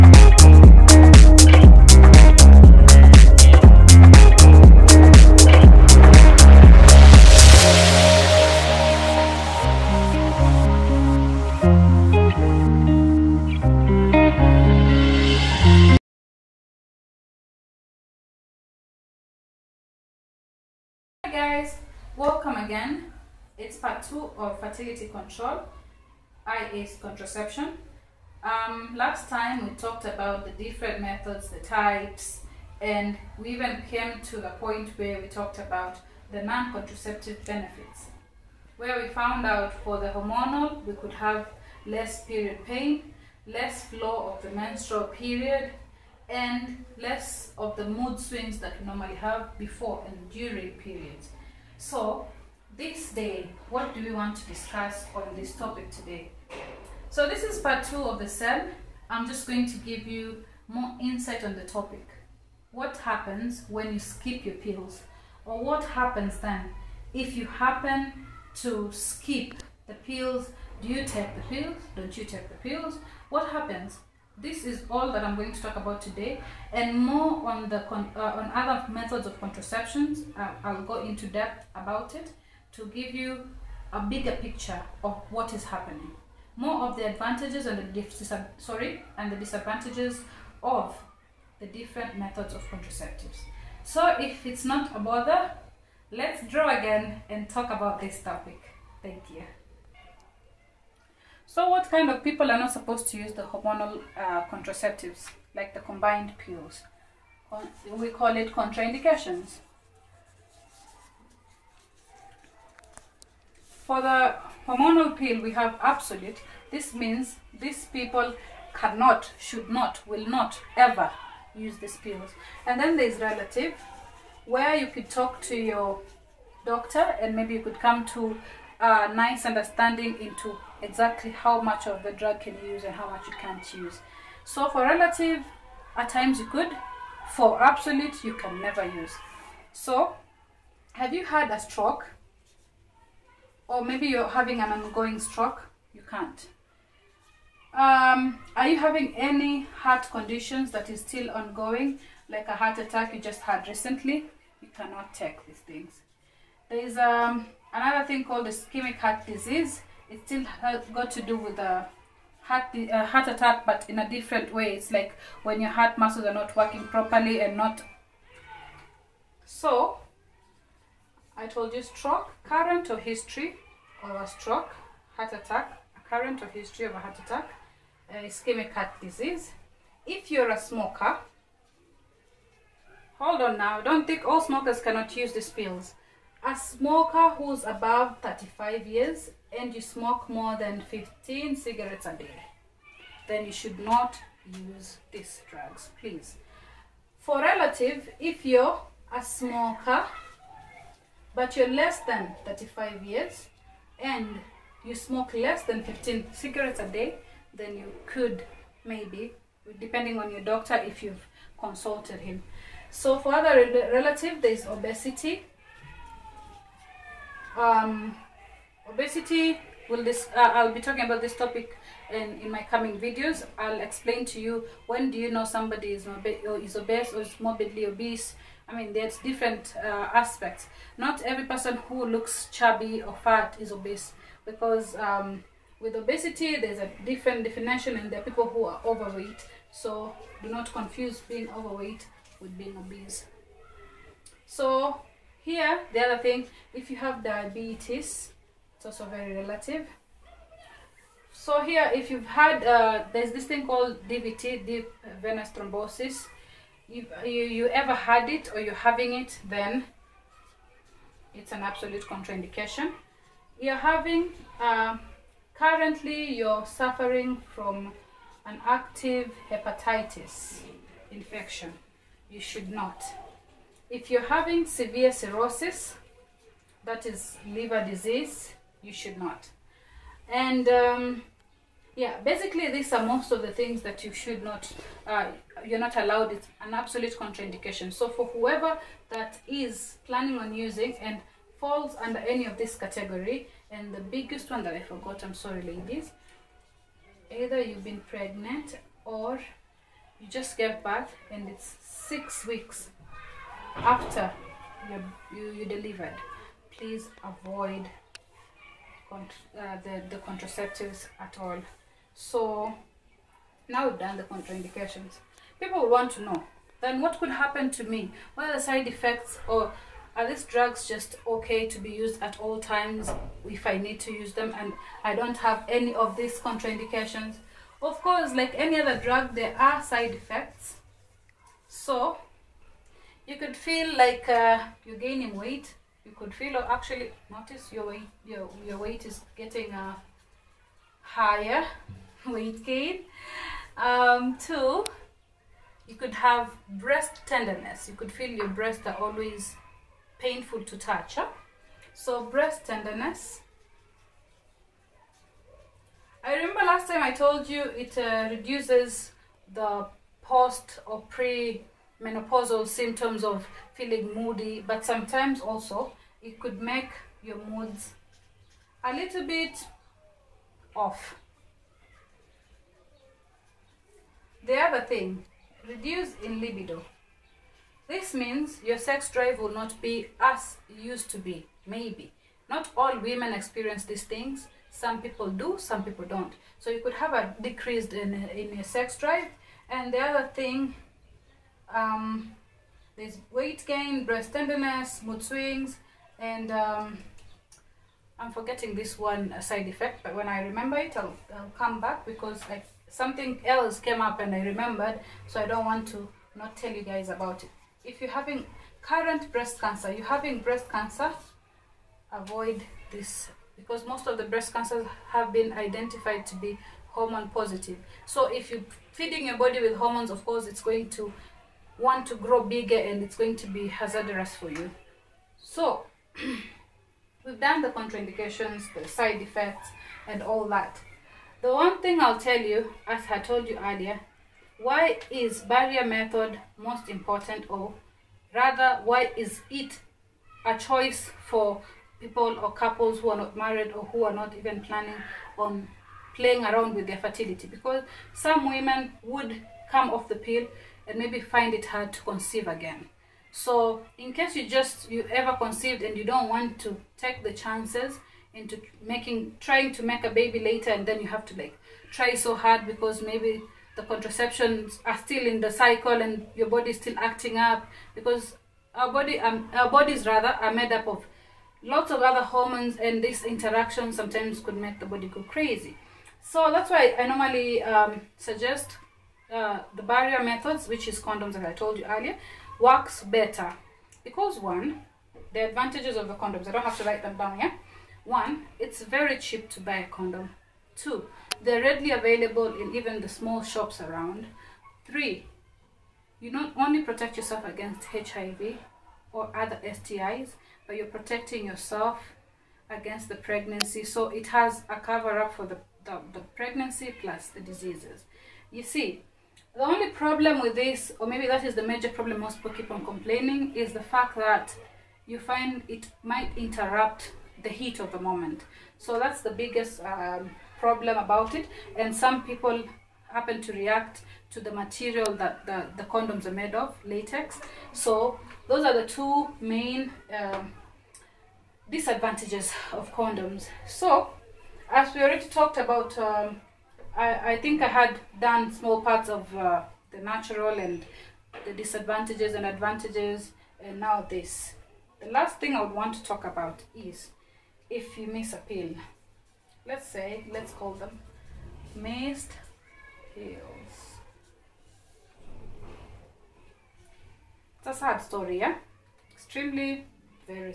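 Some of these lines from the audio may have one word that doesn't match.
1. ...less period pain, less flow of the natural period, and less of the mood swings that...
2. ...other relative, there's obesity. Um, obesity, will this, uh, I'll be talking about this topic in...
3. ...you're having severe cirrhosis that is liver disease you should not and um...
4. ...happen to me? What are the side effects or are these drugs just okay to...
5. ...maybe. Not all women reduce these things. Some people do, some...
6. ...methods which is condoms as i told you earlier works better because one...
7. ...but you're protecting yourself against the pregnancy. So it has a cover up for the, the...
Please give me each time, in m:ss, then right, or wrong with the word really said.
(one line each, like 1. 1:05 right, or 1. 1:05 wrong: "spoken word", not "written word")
1. 0:41 wrong: "menstrual", not "natural"
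2. 3:33 right
3. 4:34 right
4. 5:17 right
5. 6:21 wrong: "experience", not "reduce"
6. 8:00 right
7. 8:20 right.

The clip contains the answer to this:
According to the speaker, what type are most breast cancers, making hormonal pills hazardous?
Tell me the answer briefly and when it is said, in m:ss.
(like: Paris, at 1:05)
Hormone positive, at 6:56.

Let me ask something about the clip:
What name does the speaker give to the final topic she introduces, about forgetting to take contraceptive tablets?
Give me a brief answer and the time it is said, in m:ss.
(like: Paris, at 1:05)
Missed pills, at 9:11.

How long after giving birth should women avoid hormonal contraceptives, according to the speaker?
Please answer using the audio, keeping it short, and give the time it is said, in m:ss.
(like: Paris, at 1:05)
6 weeks, at 5:01.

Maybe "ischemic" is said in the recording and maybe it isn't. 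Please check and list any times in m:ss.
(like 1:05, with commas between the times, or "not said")
2:38, 2:58.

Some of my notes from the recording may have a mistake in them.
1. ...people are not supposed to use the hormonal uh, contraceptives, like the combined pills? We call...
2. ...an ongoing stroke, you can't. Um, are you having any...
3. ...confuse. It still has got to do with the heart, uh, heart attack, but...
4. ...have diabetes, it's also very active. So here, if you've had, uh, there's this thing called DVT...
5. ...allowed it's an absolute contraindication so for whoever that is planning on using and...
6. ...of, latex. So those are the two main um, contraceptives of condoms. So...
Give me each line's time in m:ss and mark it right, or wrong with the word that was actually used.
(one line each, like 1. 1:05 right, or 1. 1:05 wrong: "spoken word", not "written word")
1. 1:42 right
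2. 2:24 right
3. 2:39 wrong: "disease", not "confuse"
4. 4:06 wrong: "relative", not "active"
5. 4:45 right
6. 8:46 wrong: "disadvantages", not "contraceptives".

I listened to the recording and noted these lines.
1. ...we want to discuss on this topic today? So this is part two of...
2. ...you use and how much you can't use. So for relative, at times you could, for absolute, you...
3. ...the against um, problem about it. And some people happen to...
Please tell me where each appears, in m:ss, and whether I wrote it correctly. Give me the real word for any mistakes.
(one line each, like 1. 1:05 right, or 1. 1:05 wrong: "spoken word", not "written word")
1. 0:54 right
2. 2:12 right
3. 8:39 wrong: "biggest", not "against".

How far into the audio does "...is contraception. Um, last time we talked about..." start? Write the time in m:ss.
0:26.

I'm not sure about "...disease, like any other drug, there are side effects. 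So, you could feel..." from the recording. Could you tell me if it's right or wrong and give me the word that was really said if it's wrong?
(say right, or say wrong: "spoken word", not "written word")
wrong: "course", not "disease".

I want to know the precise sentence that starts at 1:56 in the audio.
This means these people cannot, should not, will not ever use these pills.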